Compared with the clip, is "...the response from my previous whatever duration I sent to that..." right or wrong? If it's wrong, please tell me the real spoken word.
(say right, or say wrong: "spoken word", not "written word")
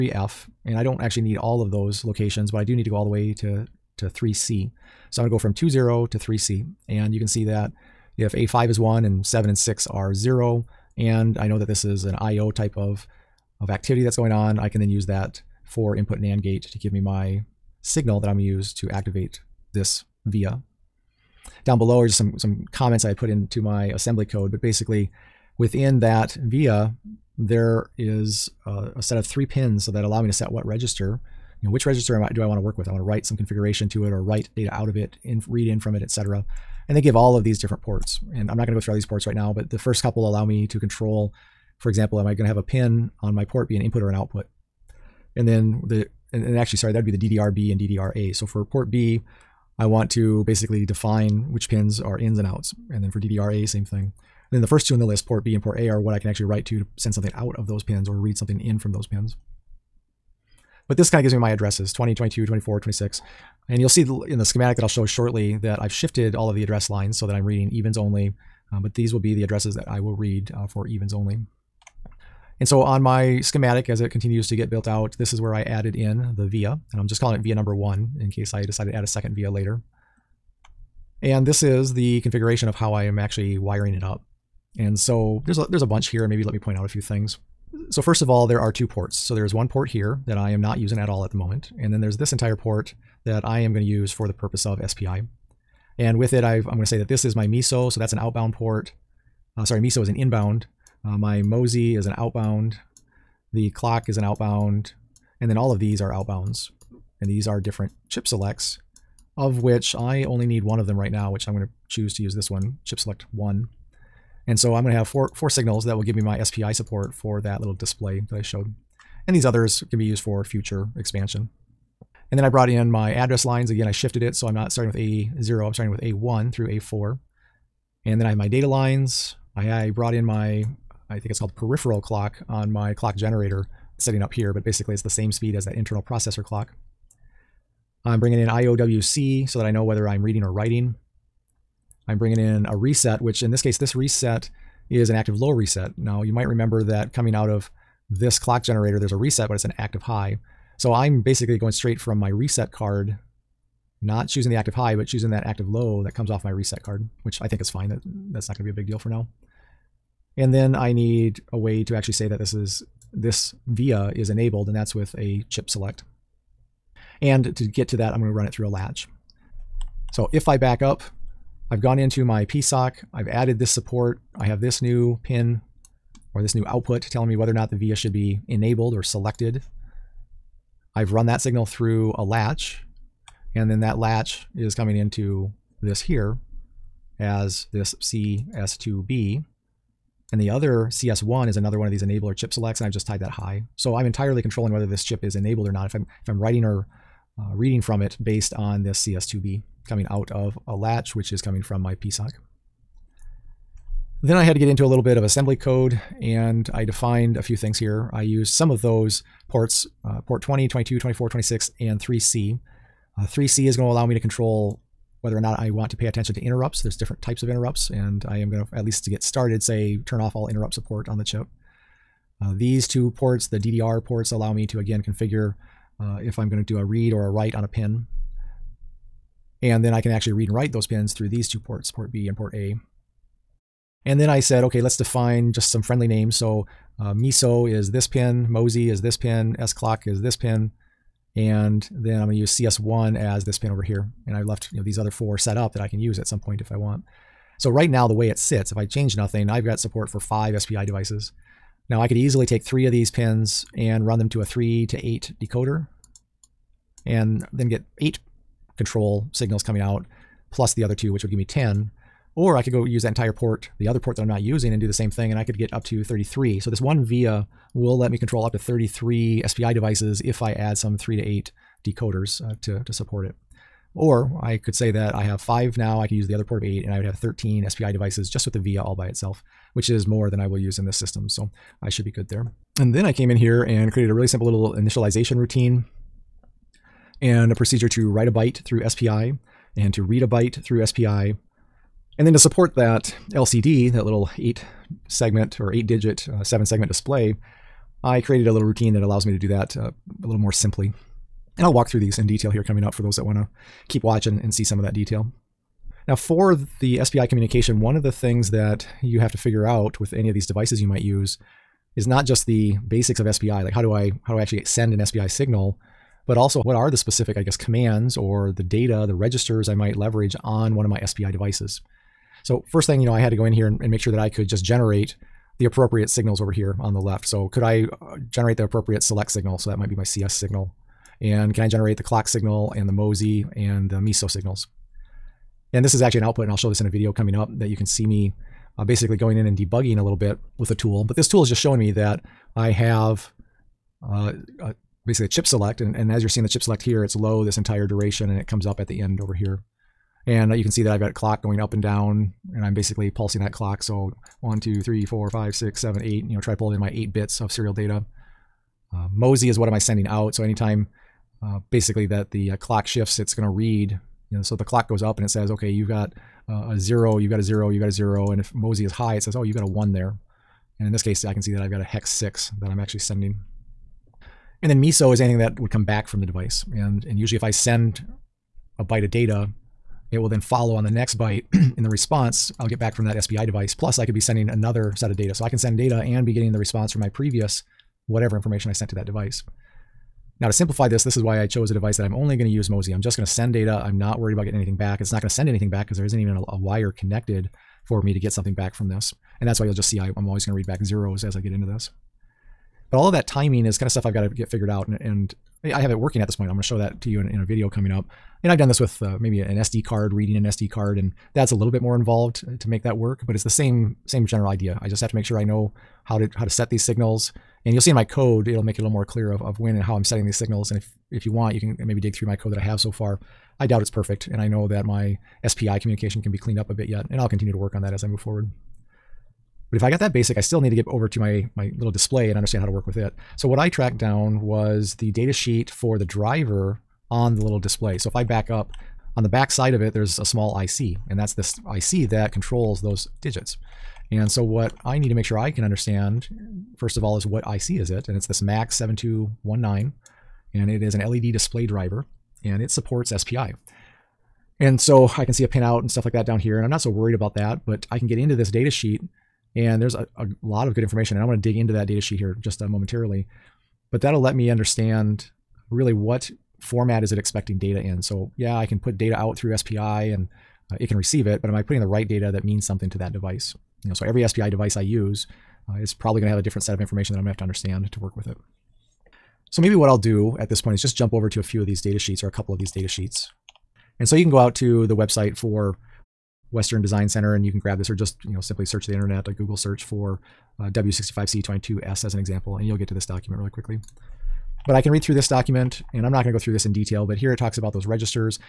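wrong: "information", not "duration".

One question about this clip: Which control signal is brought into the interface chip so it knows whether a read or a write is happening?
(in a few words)
IOWC.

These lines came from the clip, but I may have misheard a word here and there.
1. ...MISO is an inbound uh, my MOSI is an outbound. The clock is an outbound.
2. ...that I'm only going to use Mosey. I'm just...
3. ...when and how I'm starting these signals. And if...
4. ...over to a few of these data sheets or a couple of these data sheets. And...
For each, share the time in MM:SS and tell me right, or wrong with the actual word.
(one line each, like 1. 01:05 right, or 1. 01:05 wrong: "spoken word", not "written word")
1. 01:39 right
2. 06:31 right
3. 06:59 wrong: "setting", not "starting"
4. 08:01 right.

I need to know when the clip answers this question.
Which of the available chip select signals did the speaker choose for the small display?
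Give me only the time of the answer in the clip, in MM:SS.
01:52.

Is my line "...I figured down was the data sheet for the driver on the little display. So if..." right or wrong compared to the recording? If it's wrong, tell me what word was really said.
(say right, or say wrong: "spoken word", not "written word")
wrong: "tracked", not "figured".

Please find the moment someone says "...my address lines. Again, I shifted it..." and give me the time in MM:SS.
02:02.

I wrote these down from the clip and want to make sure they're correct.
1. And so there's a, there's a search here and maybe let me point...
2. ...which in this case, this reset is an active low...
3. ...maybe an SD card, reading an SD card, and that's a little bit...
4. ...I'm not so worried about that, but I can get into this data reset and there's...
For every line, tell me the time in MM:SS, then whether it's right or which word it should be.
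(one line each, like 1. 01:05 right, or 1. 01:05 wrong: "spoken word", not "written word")
1. 01:24 wrong: "bunch", not "search"
2. 02:23 right
3. 06:49 right
4. 07:36 wrong: "sheet", not "reset".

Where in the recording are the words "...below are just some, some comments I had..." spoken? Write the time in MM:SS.
00:21.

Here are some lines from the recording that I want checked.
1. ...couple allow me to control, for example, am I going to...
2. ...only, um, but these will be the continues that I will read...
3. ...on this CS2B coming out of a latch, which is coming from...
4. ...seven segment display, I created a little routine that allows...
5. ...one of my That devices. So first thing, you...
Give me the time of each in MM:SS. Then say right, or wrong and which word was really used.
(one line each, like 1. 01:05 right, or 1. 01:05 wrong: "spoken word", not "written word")
1. 00:40 right
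2. 01:07 wrong: "addresses", not "continues"
3. 03:18 right
4. 04:56 right
5. 05:20 wrong: "SPI", not "That".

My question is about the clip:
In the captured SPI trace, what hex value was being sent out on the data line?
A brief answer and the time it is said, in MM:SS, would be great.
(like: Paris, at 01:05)
hex 6, at 06:11.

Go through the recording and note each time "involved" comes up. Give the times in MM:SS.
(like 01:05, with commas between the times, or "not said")
06:51.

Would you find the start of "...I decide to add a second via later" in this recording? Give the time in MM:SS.
01:18.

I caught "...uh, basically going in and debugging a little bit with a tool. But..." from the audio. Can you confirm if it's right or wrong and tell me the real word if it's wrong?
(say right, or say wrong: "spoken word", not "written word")
right.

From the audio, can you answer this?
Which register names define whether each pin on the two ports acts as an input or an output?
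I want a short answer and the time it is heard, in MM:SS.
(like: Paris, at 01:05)
DDRB and DDRA, at 00:47.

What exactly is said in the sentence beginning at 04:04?
And I left you know these other four set up that I can use at some point if I want.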